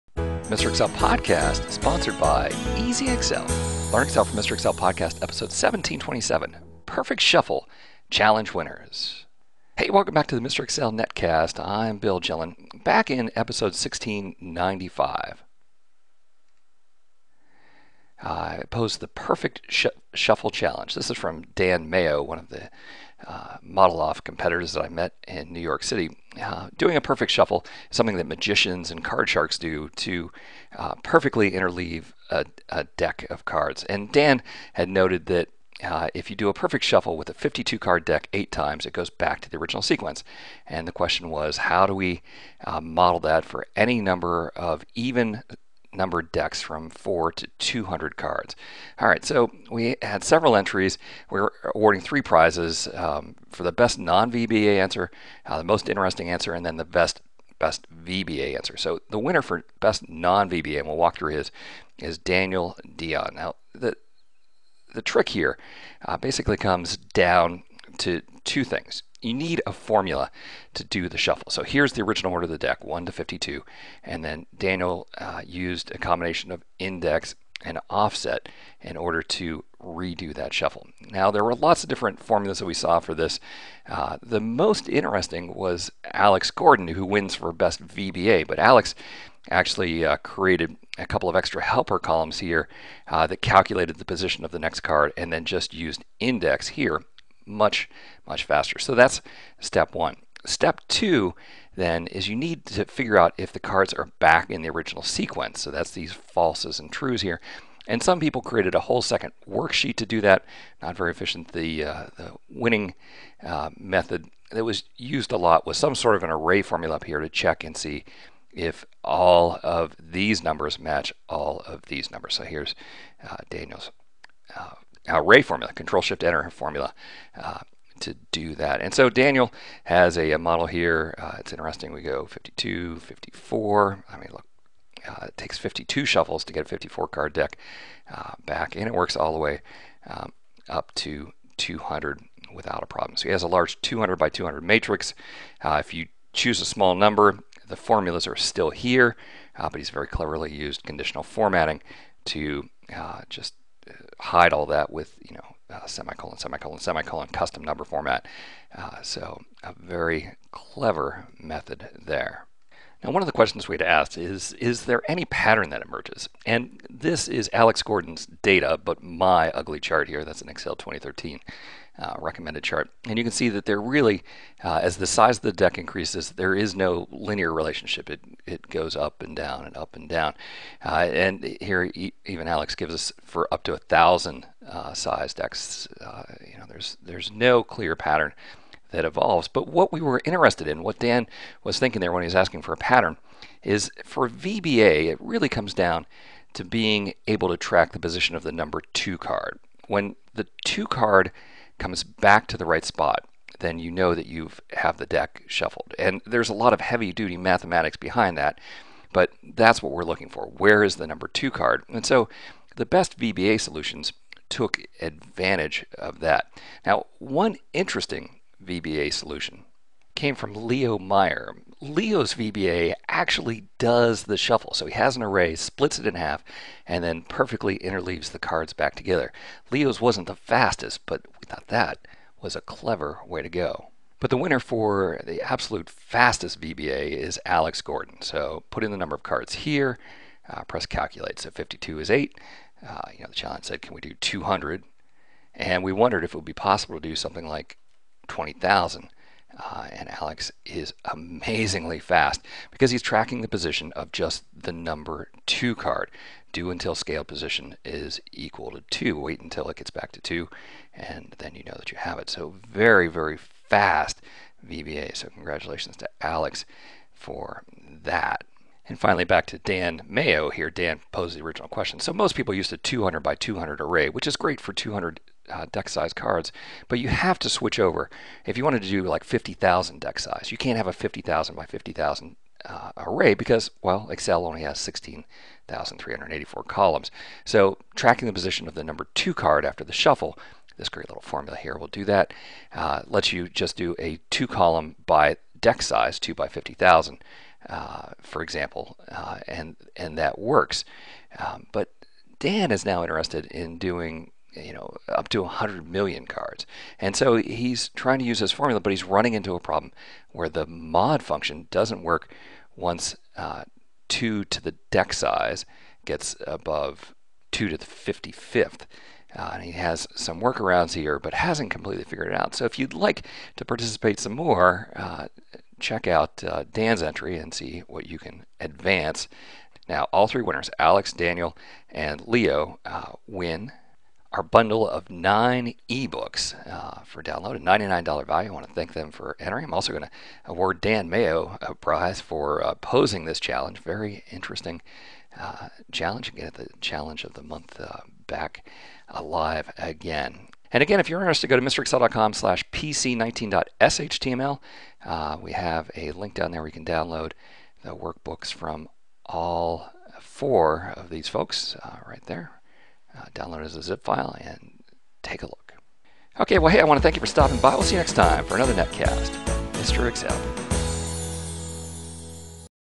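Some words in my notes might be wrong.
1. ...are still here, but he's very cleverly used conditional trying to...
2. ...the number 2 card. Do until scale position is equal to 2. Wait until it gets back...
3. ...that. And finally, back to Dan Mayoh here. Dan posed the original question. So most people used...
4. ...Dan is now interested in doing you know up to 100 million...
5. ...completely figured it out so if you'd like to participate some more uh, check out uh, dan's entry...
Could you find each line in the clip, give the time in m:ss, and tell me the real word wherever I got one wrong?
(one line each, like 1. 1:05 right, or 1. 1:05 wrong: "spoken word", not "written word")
1. 2:28 wrong: "formatting", not "trying"
2. 4:14 right
3. 4:28 right
4. 5:02 right
5. 5:21 right.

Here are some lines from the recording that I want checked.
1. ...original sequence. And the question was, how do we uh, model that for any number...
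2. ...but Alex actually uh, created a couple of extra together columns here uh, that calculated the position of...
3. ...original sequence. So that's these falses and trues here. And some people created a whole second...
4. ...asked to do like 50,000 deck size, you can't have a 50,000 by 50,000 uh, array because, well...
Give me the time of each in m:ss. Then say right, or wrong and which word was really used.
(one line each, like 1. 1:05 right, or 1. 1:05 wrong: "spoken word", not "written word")
1. 0:39 right
2. 1:28 wrong: "helper", not "together"
3. 1:44 right
4. 4:38 wrong: "wanted", not "asked".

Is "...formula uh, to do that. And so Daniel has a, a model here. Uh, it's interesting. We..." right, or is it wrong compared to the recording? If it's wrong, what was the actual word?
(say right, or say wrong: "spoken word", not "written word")
right.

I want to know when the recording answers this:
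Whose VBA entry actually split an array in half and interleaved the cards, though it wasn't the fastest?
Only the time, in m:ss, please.
3:40.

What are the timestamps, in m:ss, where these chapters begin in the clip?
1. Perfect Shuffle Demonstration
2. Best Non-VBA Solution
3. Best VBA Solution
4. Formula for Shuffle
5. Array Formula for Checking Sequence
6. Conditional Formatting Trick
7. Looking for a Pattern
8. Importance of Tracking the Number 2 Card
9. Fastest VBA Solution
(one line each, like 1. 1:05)
1. 0:26
2. 0:48
3. 1:03
4. 1:13
5. 1:47
6. 2:02
7. 2:39
8. 3:14
9. 3:36.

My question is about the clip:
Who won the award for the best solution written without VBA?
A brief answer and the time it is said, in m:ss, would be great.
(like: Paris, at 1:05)
Daniel Dion, at 1:02.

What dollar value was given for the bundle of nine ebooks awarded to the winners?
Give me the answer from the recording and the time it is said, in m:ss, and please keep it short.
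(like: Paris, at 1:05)
$99, at 5:37.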